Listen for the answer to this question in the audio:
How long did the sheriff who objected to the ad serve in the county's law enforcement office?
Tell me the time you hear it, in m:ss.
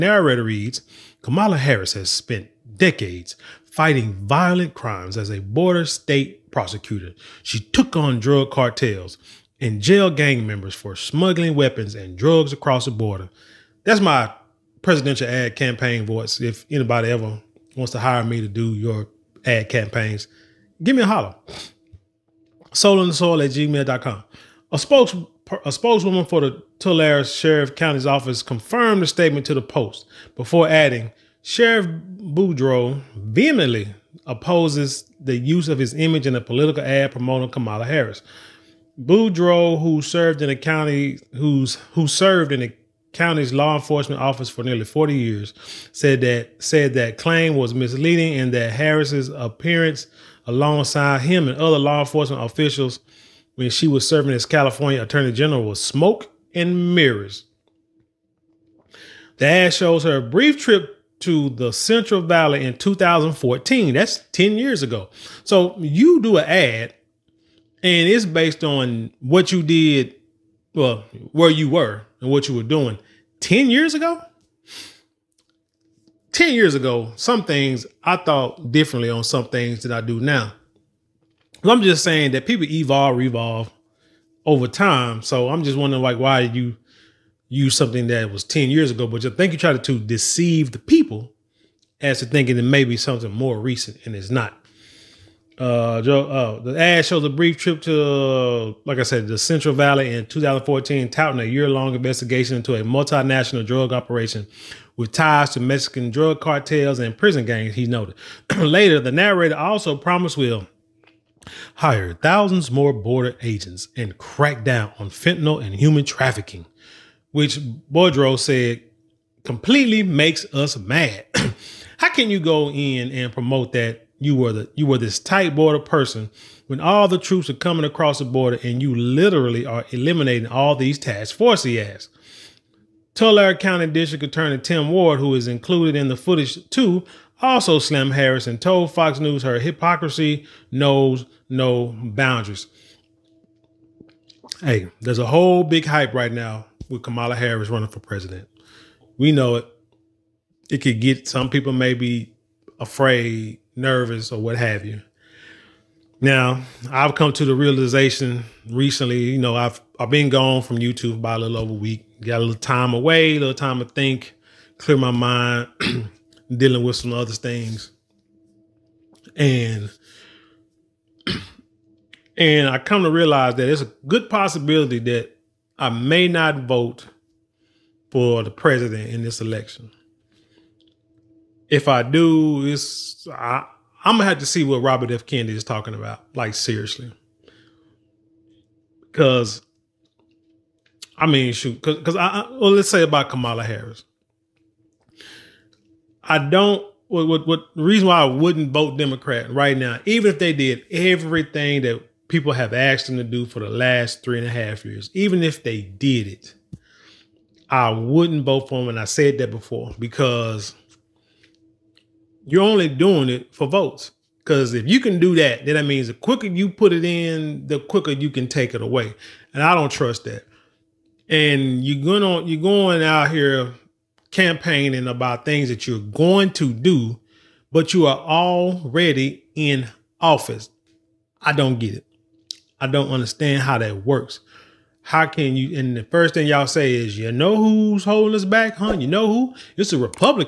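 0:44.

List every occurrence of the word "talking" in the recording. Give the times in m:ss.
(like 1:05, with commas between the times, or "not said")
3:05.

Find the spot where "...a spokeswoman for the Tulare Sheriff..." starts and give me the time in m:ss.
0:25.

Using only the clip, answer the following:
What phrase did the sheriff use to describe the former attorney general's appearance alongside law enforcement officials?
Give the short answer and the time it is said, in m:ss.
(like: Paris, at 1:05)
smoke and mirrors, at 0:55.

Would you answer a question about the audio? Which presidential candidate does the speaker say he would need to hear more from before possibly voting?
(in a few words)
Robert F. Kennedy.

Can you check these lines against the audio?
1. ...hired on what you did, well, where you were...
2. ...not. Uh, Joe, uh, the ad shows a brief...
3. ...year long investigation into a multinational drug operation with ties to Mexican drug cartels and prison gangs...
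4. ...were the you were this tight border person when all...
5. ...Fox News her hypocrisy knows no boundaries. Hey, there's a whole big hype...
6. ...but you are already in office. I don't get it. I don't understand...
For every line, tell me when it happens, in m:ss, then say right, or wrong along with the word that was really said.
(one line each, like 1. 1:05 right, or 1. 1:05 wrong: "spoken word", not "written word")
1. 1:08 wrong: "based", not "hired"
2. 1:34 right
3. 1:41 right
4. 2:04 right
5. 2:18 right
6. 3:47 right.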